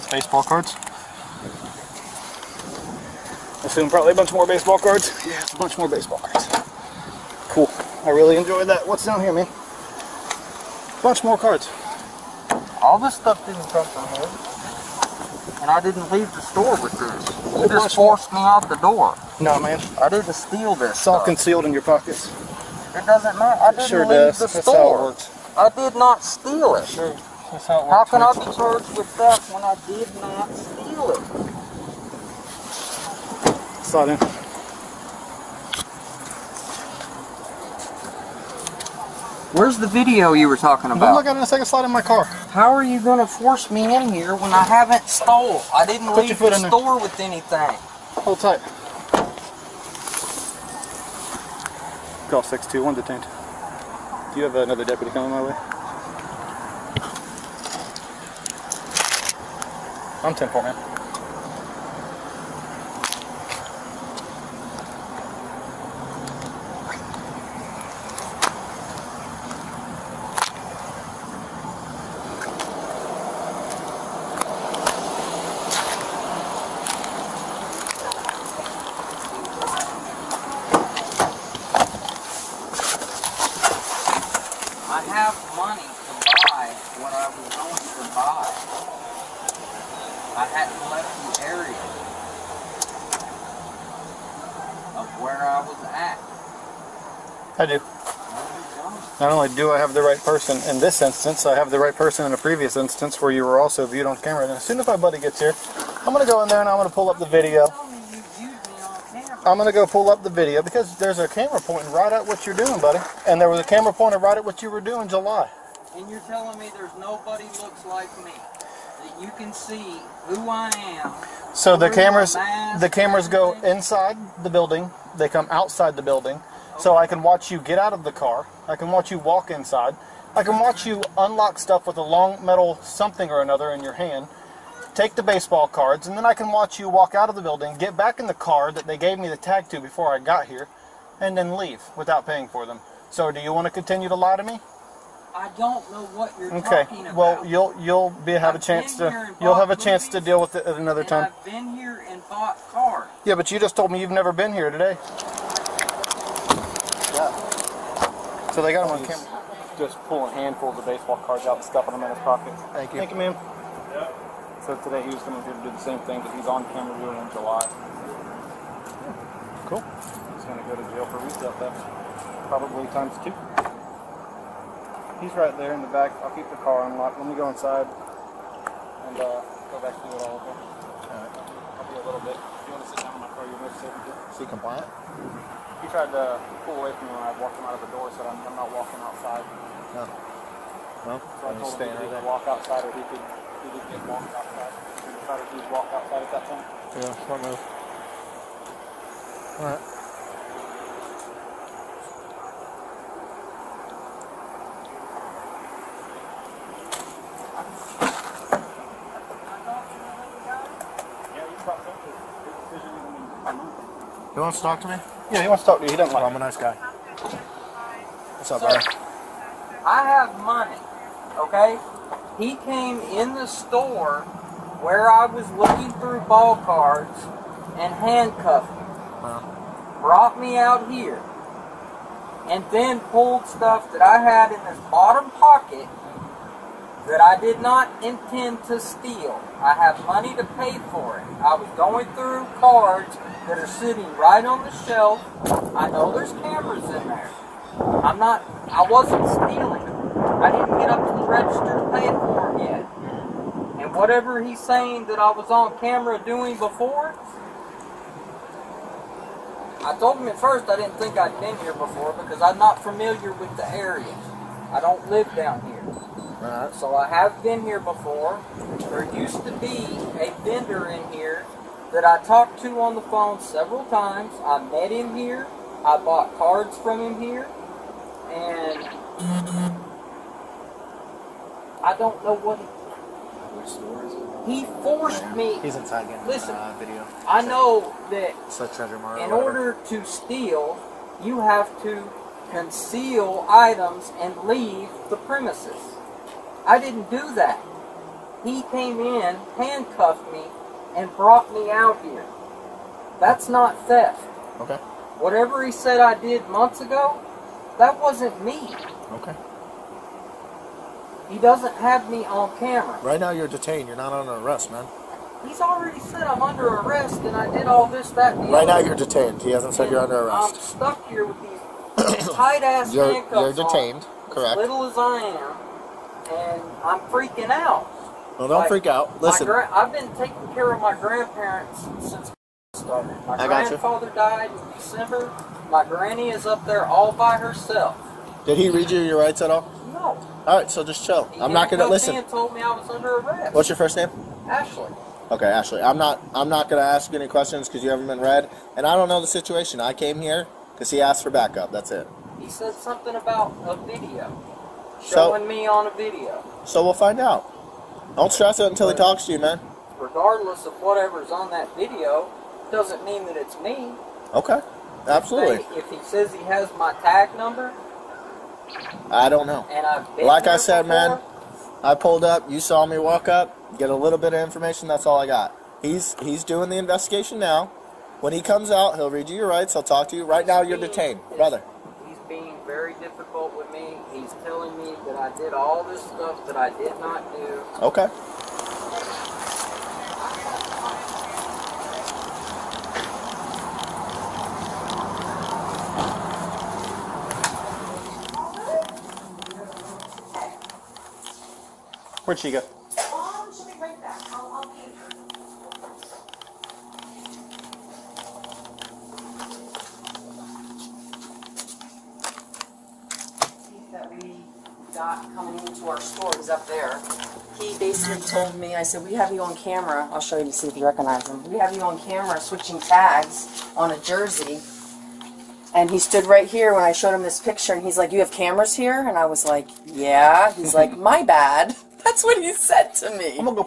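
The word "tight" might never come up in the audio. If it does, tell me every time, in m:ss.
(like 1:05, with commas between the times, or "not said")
0:48, 5:22.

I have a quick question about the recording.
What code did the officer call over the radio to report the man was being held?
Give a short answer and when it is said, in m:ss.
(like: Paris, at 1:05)
621, at 0:52.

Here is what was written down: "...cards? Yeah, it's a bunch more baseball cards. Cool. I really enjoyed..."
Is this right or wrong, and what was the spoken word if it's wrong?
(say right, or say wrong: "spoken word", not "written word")
right.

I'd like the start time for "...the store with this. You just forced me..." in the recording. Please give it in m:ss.
0:16.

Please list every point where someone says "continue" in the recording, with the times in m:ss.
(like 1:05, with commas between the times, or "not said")
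2:23.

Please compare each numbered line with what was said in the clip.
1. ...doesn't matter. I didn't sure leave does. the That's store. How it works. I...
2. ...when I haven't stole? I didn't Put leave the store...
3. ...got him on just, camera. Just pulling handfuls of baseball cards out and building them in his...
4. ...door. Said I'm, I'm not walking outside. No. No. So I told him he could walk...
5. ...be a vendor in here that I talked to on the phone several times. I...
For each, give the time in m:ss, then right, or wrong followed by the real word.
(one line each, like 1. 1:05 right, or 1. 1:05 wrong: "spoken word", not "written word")
1. 0:23 right
2. 0:44 right
3. 2:38 wrong: "stuffing", not "building"
4. 3:07 right
5. 4:29 right.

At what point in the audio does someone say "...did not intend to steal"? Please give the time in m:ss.
3:57.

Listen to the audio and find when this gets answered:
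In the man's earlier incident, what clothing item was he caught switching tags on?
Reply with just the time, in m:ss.
7:03.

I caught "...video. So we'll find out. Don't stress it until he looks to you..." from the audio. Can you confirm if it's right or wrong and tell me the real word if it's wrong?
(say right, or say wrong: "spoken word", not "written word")
wrong: "talks", not "looks".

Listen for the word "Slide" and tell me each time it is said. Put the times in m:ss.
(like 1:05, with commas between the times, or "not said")
0:33, 0:41.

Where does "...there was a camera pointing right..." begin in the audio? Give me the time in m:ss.
1:53.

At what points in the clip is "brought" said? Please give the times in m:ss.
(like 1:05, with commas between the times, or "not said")
3:50, 5:01.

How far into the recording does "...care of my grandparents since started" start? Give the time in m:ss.
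5:30.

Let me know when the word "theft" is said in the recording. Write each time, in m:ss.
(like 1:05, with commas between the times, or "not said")
0:29, 2:51, 5:03.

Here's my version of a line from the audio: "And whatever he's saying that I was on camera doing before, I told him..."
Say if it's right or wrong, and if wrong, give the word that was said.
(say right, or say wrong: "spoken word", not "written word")
right.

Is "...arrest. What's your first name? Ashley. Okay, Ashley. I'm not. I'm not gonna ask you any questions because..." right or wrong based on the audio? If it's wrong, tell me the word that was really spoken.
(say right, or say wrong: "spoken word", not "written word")
right.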